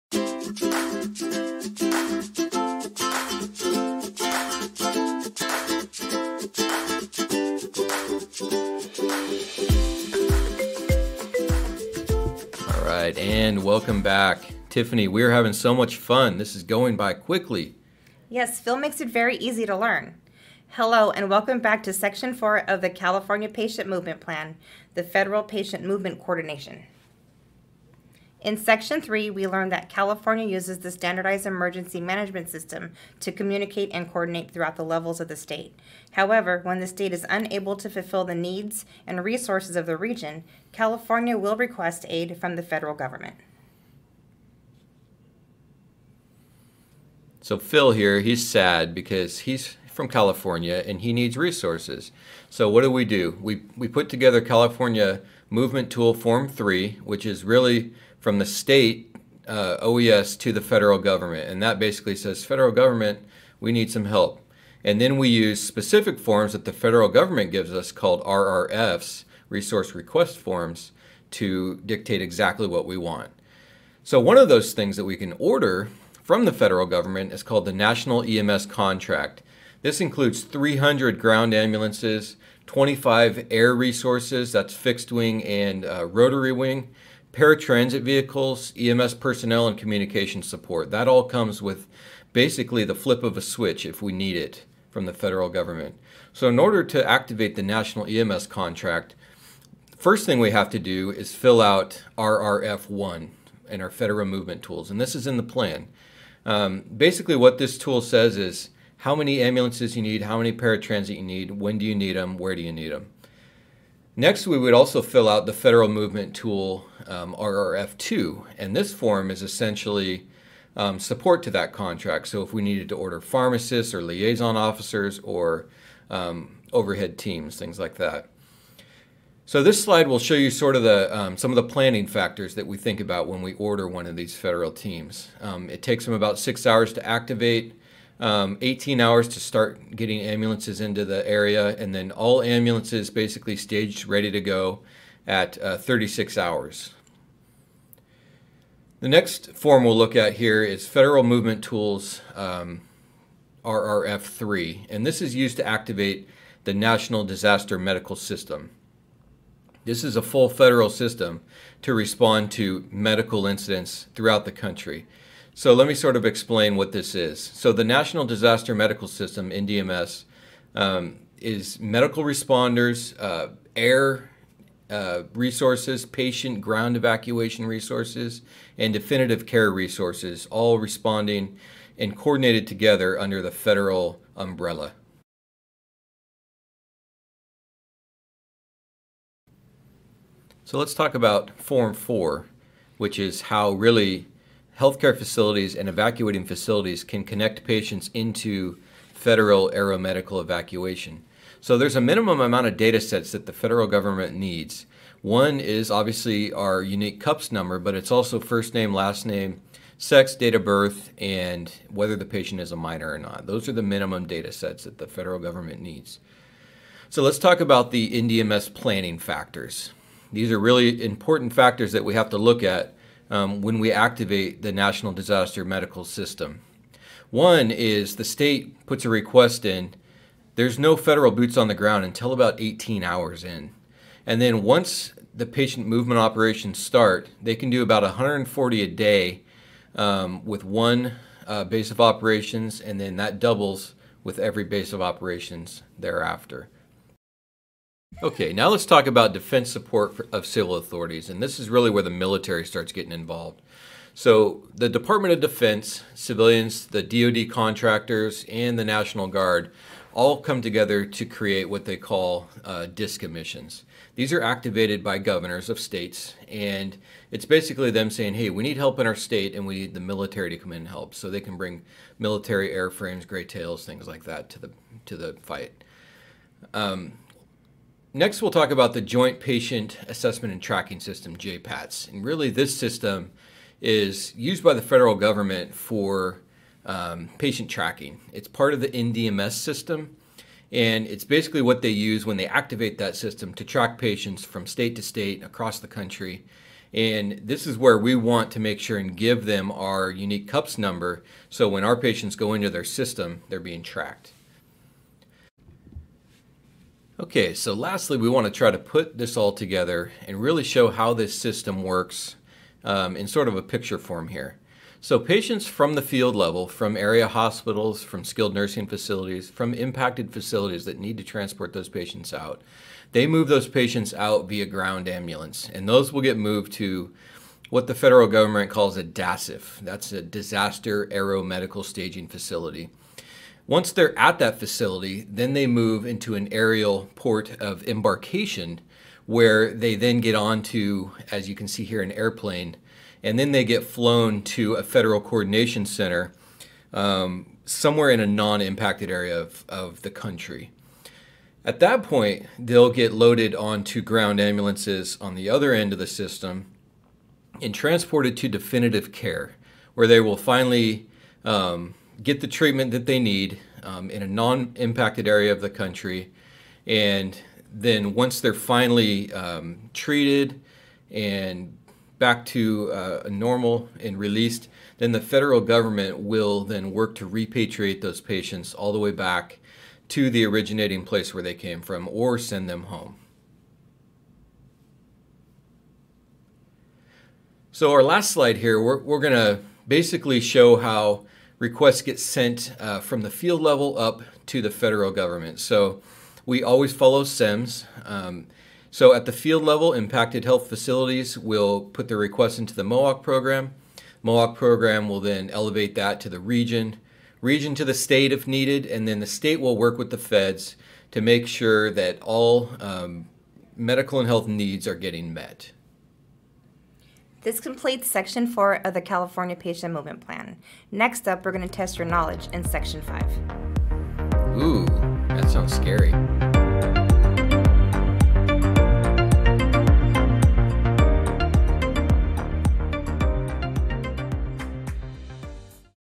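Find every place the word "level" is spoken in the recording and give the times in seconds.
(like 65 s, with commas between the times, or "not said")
34 s, 316 s, 393 s, 399 s.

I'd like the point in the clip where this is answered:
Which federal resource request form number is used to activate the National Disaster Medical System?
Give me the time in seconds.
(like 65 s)
153 s.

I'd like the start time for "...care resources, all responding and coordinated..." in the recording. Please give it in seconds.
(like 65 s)
179 s.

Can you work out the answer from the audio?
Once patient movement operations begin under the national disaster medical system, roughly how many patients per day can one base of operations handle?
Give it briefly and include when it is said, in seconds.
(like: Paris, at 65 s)
140, at 238 s.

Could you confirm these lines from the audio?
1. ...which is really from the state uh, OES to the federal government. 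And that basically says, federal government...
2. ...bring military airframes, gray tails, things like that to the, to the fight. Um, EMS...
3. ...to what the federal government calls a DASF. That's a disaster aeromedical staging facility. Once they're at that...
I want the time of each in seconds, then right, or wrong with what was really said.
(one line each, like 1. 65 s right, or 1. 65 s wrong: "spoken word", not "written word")
1. 57 s right
2. 271 s wrong: "Next", not "EMS"
3. 326 s right.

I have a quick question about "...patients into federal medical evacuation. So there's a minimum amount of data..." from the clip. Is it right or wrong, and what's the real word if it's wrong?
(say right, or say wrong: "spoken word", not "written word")
wrong: "aeromedical", not "medical".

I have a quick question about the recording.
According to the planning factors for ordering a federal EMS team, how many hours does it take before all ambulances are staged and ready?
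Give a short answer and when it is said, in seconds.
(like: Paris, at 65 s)
36 hours, at 145 s.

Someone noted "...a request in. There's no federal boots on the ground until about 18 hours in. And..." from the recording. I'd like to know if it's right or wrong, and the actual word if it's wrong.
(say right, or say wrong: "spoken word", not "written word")
right.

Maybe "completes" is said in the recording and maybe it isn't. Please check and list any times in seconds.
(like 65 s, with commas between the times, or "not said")
417 s.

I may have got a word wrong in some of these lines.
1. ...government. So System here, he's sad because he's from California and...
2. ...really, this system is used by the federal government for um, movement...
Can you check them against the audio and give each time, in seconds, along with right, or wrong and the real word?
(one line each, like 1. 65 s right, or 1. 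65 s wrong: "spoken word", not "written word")
1. 42 s wrong: "Phil", not "System"
2. 282 s wrong: "patient", not "movement".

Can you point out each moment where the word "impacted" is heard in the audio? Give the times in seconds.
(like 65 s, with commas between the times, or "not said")
319 s, 348 s, 364 s, 399 s.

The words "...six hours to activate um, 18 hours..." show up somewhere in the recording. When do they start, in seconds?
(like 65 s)
136 s.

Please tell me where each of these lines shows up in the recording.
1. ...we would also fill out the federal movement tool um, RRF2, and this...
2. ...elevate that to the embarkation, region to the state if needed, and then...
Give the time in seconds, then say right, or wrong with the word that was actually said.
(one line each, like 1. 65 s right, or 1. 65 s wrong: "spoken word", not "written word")
1. 114 s right
2. 405 s wrong: "region", not "embarkation".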